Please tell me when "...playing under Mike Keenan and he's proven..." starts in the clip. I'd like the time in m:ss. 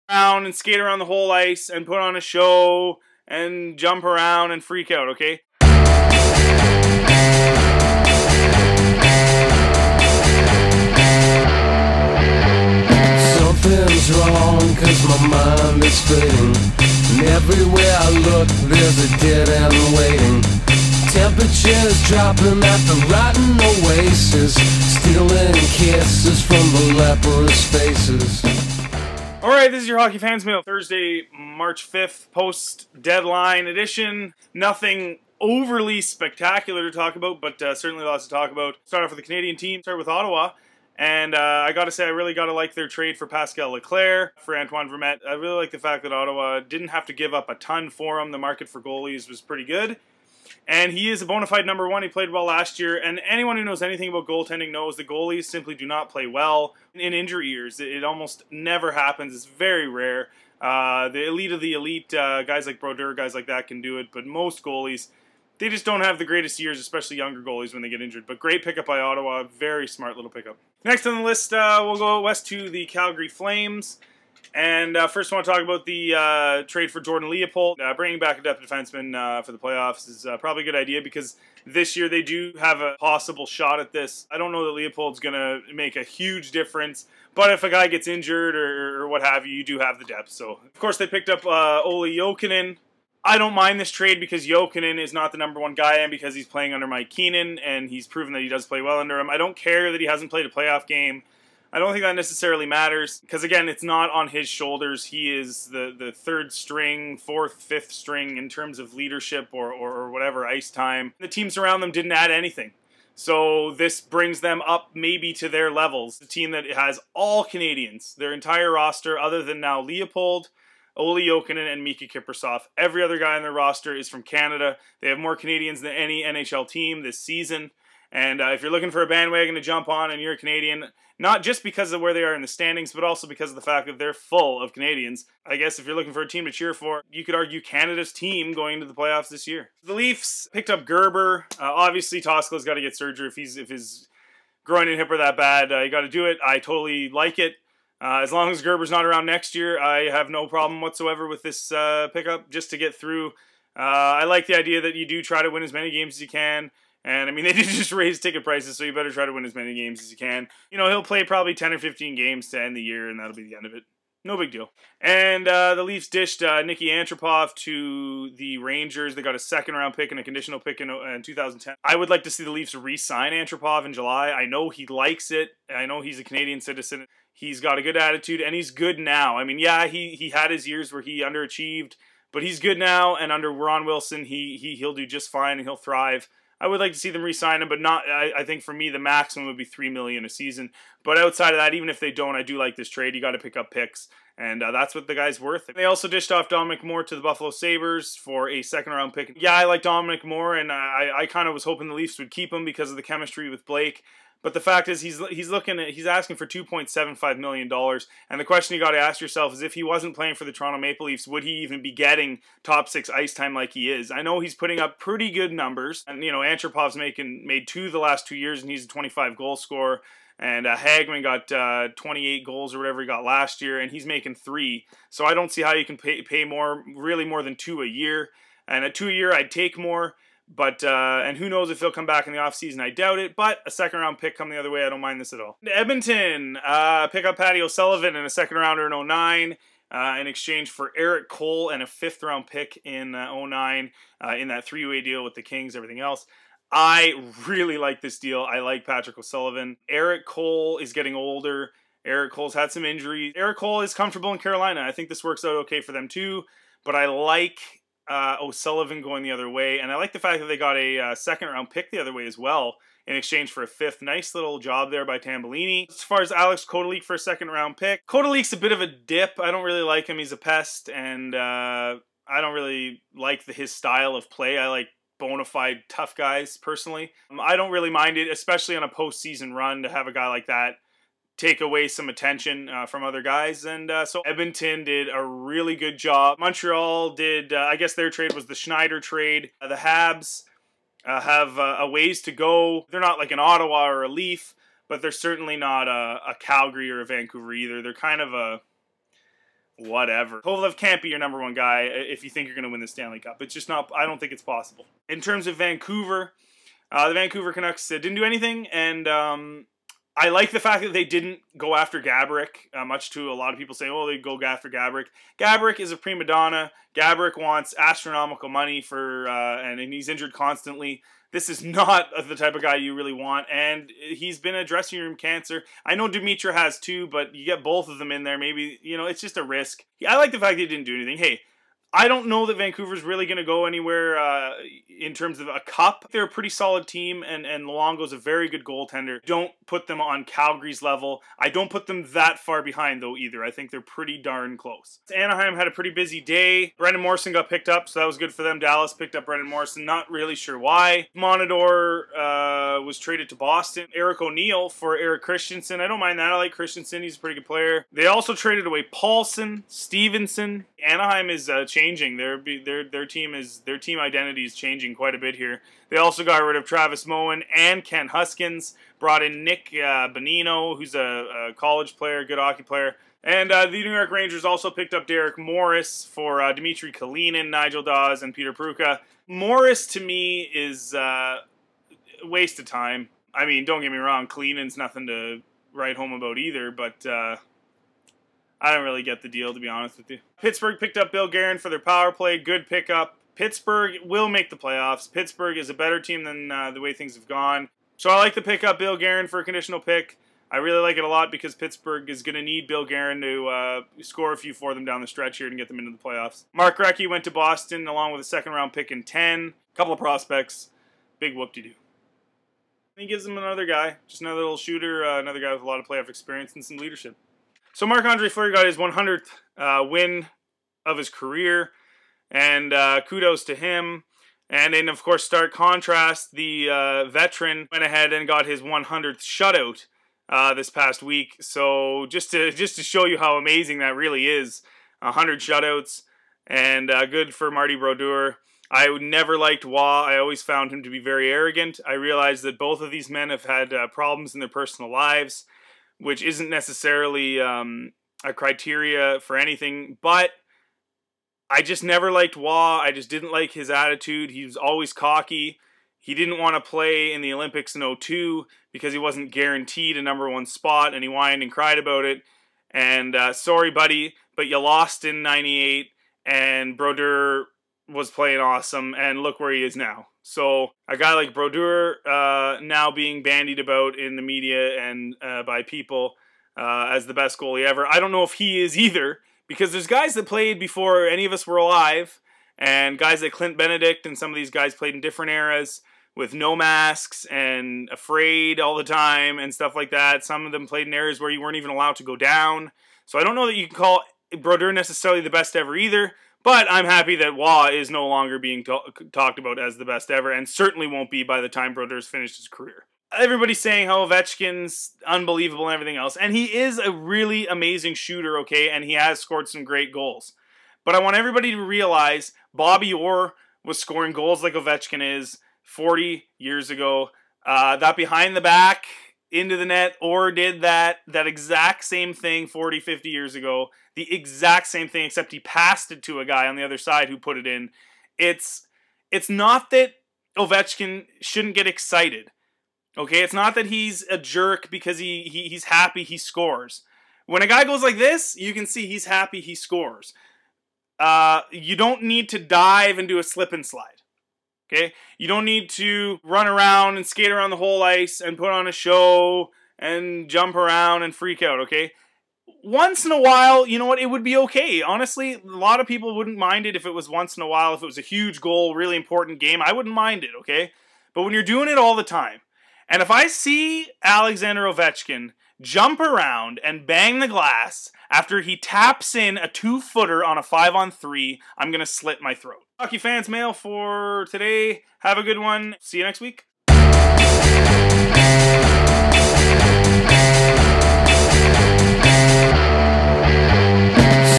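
1:36.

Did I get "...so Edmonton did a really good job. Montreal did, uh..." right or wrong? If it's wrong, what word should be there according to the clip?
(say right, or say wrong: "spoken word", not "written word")
right.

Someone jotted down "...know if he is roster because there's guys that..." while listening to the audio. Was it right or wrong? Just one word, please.
wrong.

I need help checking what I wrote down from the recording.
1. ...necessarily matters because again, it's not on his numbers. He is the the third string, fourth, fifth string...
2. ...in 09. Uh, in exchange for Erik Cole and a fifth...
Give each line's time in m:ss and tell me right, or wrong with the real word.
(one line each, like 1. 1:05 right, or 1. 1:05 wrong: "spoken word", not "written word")
1. 1:42 wrong: "shoulders", not "numbers"
2. 3:58 right.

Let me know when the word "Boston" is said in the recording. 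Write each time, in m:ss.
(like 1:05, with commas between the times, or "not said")
5:53, 6:47.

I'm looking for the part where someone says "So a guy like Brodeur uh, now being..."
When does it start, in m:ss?
7:50.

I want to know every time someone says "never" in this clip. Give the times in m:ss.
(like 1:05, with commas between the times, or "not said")
0:58, 7:19, 7:31.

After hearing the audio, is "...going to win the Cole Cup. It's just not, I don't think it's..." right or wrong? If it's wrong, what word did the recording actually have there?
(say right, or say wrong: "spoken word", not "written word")
wrong: "Stanley", not "Cole".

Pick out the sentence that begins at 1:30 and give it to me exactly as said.
So, of course, they picked up uh, Olli Jokinen.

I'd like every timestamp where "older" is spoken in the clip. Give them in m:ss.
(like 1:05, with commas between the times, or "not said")
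4:11.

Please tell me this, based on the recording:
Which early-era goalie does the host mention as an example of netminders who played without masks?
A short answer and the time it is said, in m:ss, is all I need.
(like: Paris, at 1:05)
Clint Benedict, at 8:03.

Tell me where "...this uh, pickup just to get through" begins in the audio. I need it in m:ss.
2:31.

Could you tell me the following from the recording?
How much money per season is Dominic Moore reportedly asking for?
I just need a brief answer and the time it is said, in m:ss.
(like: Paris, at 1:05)
2.75 million dollars, at 3:26.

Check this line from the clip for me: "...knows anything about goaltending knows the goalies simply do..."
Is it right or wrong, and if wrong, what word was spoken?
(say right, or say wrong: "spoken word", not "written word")
right.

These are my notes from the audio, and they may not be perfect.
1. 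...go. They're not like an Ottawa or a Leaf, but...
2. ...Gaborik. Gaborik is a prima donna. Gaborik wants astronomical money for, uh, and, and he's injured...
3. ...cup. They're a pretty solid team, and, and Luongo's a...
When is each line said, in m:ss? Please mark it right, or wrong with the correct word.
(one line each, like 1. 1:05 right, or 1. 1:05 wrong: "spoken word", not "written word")
1. 4:52 right
2. 5:14 right
3. 5:35 right.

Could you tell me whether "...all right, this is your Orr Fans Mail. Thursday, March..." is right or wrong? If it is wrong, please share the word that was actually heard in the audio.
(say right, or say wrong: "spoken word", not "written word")
wrong: "Hockey", not "Orr".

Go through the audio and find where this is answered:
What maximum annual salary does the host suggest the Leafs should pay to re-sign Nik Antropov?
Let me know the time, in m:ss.
3:09.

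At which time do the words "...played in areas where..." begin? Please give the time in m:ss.
8:10.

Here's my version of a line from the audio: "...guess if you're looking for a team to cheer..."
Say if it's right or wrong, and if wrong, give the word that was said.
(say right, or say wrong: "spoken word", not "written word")
right.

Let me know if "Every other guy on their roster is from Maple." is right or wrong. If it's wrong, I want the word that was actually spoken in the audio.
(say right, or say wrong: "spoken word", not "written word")
wrong: "Canada", not "Maple".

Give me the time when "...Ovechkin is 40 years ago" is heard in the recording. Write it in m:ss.
8:34.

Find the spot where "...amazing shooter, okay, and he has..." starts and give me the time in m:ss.
8:27.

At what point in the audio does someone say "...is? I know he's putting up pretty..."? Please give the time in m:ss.
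3:33.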